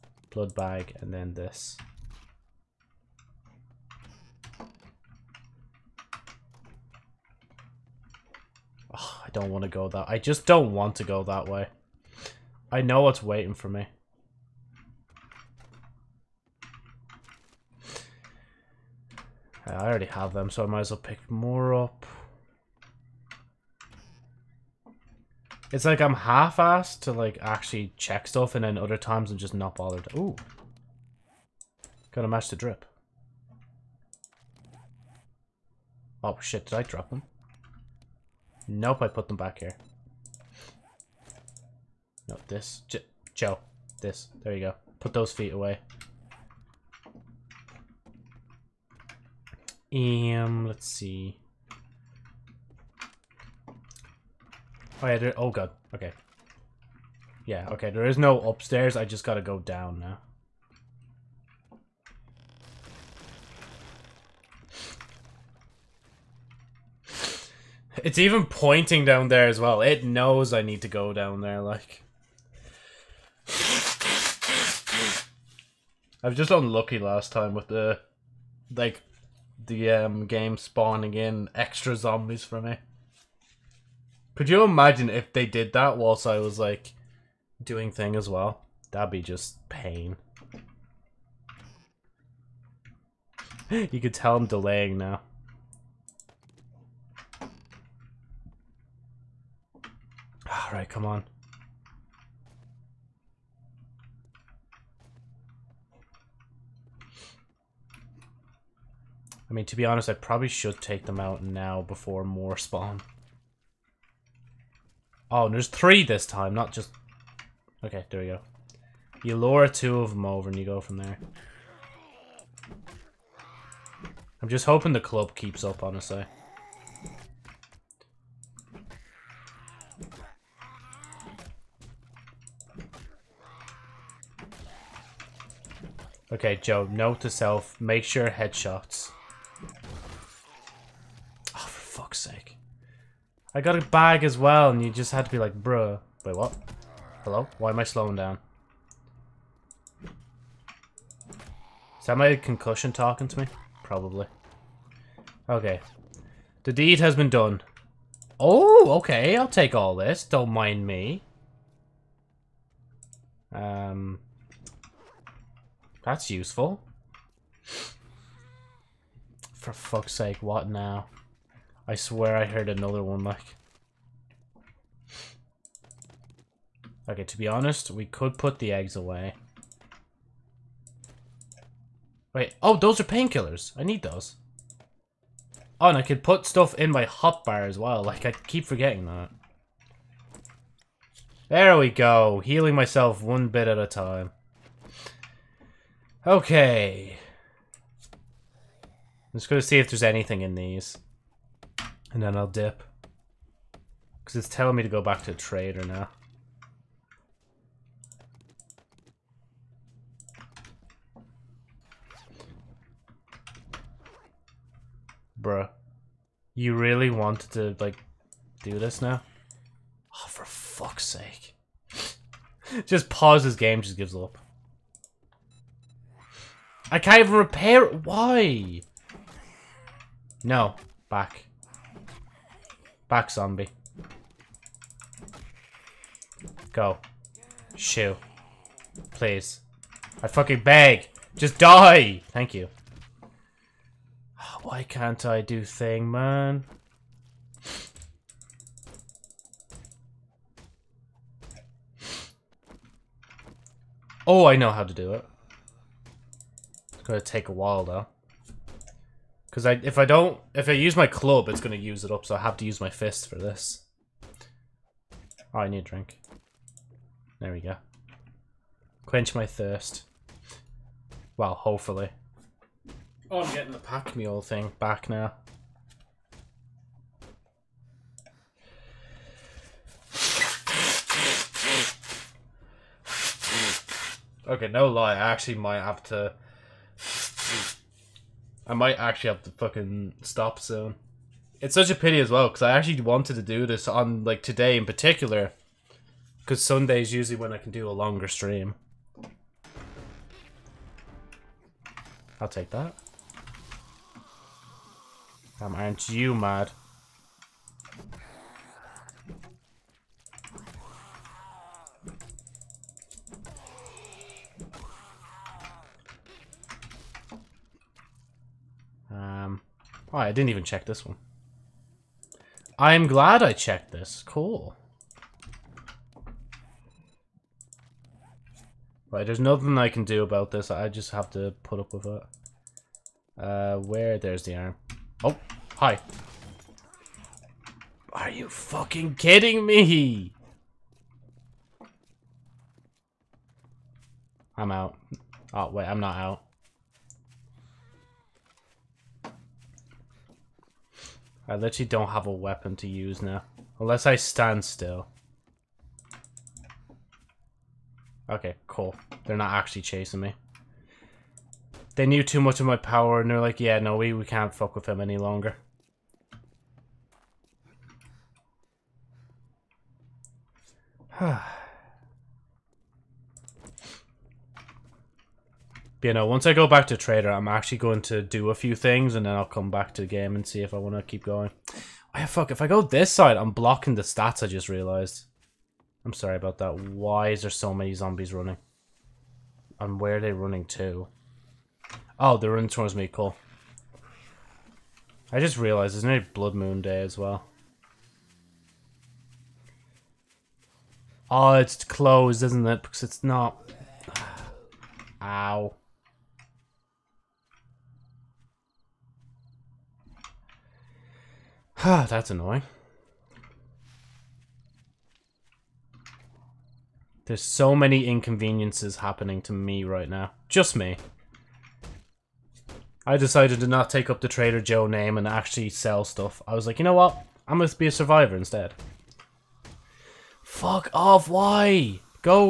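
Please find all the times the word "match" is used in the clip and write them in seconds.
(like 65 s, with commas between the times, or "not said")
32 s.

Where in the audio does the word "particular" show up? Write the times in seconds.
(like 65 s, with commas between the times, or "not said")
294 s.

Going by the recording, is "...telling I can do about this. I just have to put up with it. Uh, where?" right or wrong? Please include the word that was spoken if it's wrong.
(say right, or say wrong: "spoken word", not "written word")
wrong: "nothing", not "telling".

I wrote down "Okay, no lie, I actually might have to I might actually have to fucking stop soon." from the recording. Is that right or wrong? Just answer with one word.
right.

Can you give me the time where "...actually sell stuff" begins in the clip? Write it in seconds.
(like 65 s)
425 s.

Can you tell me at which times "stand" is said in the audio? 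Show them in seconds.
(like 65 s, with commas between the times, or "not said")
354 s.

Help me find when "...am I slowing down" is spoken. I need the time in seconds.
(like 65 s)
147 s.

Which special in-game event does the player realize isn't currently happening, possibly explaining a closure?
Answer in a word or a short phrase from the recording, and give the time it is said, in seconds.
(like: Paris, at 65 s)
Blood Moon, at 396 s.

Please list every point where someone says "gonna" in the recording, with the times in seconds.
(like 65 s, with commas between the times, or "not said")
257 s.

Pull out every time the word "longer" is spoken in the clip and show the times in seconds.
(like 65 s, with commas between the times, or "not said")
297 s, 365 s.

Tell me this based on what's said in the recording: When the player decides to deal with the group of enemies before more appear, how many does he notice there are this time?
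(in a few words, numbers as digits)
3.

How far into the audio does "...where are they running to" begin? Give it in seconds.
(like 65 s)
390 s.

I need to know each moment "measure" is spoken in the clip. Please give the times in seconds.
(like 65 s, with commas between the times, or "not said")
not said.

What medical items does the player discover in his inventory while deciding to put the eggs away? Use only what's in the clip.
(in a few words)
Painkillers.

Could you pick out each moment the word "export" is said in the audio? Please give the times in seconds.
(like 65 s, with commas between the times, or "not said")
not said.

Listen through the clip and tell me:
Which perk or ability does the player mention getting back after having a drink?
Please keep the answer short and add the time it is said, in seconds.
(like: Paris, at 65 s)
Pack mule, at 273 s.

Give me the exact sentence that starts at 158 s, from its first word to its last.
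Oh, okay, I'll take all this.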